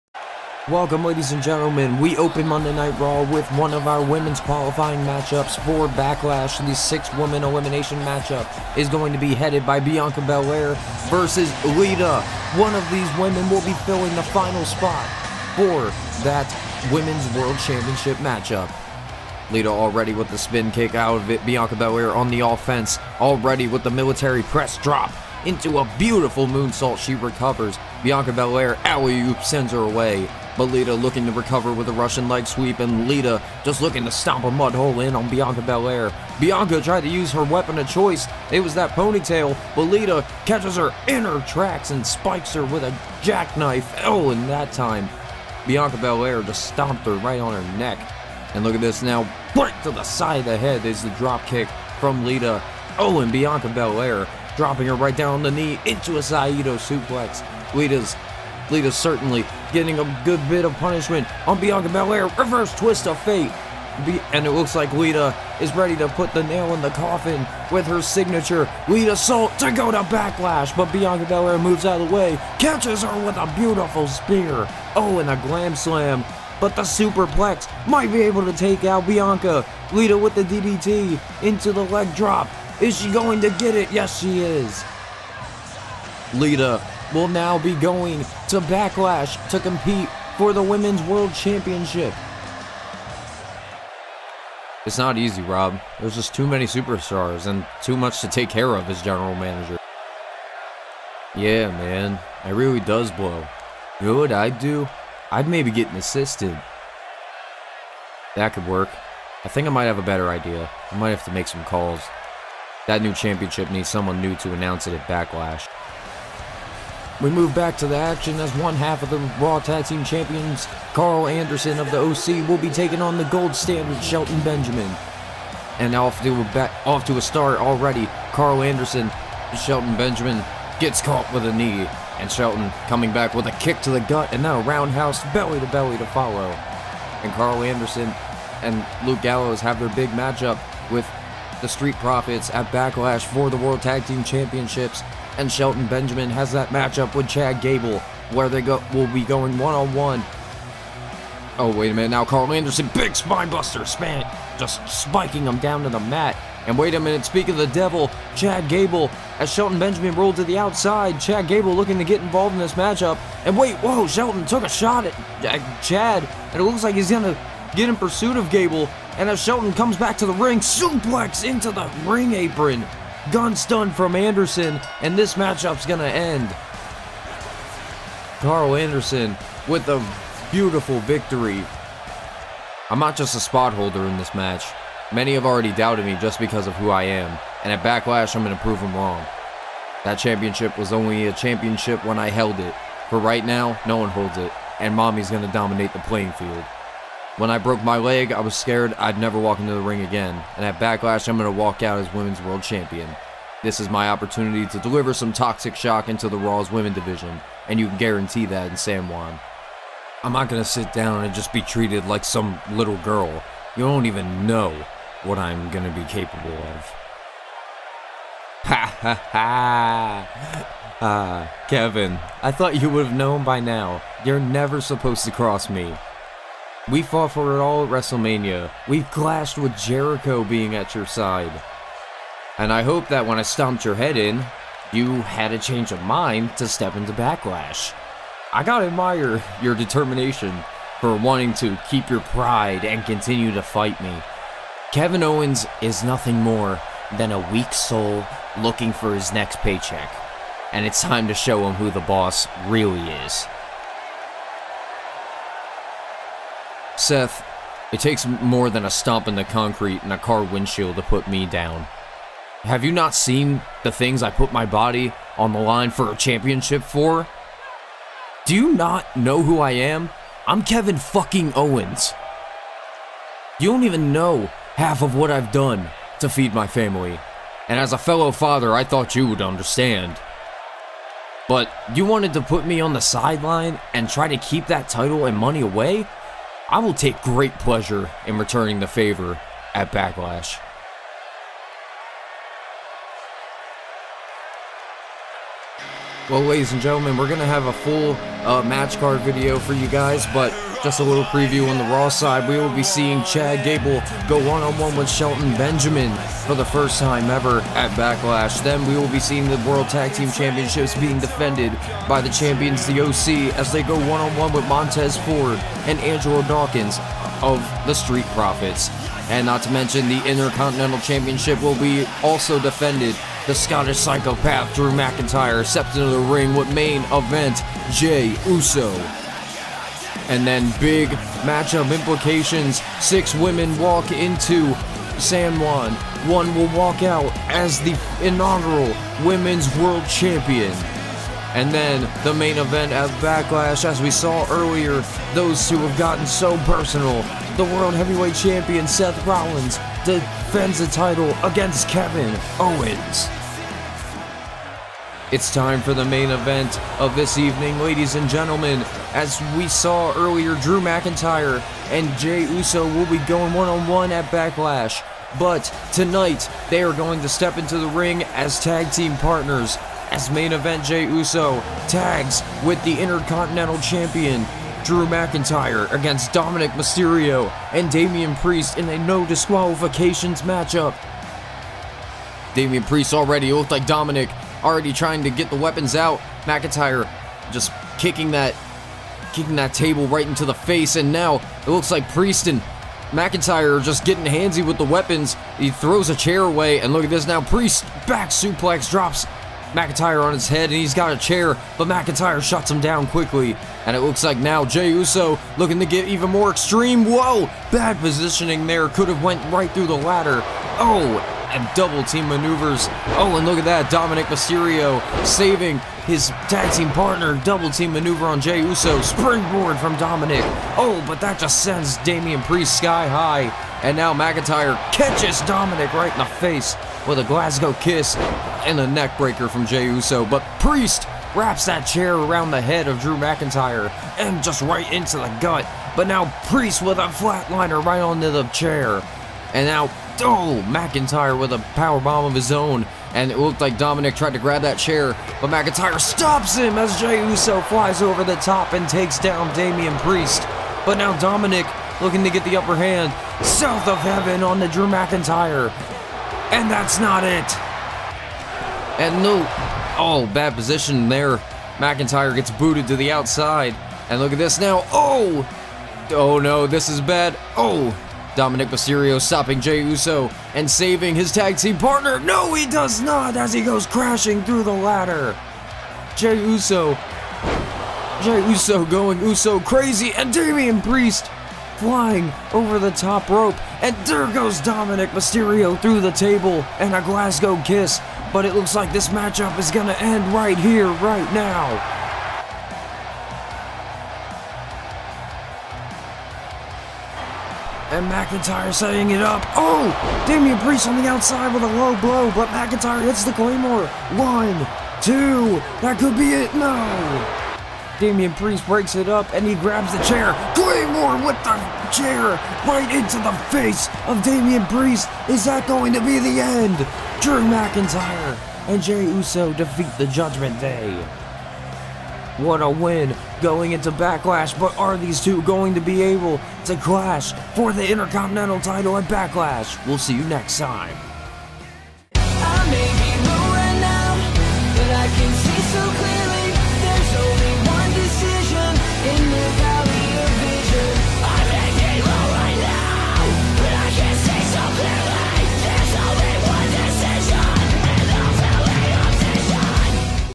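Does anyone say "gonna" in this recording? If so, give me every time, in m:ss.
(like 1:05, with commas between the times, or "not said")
2:47, 2:55, 3:08, 3:15.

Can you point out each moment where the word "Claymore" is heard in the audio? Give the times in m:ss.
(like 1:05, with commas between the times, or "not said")
8:23, 8:30.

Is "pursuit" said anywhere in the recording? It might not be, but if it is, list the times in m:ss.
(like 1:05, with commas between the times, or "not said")
2:47.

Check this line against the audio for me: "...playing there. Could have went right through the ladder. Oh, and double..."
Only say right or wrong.
wrong.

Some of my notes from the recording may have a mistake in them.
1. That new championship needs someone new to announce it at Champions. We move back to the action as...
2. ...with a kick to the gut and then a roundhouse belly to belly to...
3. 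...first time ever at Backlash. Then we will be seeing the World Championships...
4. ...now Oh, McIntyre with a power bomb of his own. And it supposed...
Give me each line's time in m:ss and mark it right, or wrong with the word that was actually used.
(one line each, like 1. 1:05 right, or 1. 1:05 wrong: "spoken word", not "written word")
1. 1:52 wrong: "Backlash", not "Champions"
2. 2:13 right
3. 5:06 wrong: "Tag", not "Championships"
4. 7:19 wrong: "looked", not "supposed".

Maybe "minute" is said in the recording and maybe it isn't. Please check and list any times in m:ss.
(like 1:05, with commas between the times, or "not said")
2:31, 2:36.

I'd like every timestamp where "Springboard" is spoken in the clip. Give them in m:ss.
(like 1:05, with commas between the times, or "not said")
6:59.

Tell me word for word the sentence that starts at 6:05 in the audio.
But tonight, they are going to step into the ring as tag team partners.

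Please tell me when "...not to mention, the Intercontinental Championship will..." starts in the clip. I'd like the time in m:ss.
5:19.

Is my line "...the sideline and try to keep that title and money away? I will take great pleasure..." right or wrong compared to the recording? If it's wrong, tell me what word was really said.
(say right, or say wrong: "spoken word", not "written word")
right.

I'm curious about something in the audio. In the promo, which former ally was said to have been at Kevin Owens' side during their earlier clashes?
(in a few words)
Jericho.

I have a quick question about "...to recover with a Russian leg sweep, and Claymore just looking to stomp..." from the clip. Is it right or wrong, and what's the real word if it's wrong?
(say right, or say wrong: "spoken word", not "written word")
wrong: "Lita", not "Claymore".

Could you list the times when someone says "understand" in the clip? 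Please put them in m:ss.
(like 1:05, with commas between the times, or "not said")
4:39.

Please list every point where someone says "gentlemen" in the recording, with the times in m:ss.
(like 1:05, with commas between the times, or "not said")
0:01, 4:56, 5:58.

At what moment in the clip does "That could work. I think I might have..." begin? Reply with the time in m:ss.
1:48.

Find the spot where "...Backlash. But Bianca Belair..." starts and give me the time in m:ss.
1:10.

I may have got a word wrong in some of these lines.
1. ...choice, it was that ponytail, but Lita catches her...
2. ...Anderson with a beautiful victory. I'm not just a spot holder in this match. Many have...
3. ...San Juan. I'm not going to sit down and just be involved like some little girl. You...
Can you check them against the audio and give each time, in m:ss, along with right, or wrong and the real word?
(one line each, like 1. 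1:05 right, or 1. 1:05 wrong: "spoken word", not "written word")
1. 0:37 right
2. 2:58 right
3. 3:28 wrong: "treated", not "involved".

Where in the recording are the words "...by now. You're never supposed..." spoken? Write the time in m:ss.
3:43.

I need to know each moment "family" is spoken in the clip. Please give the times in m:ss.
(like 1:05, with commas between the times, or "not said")
4:36.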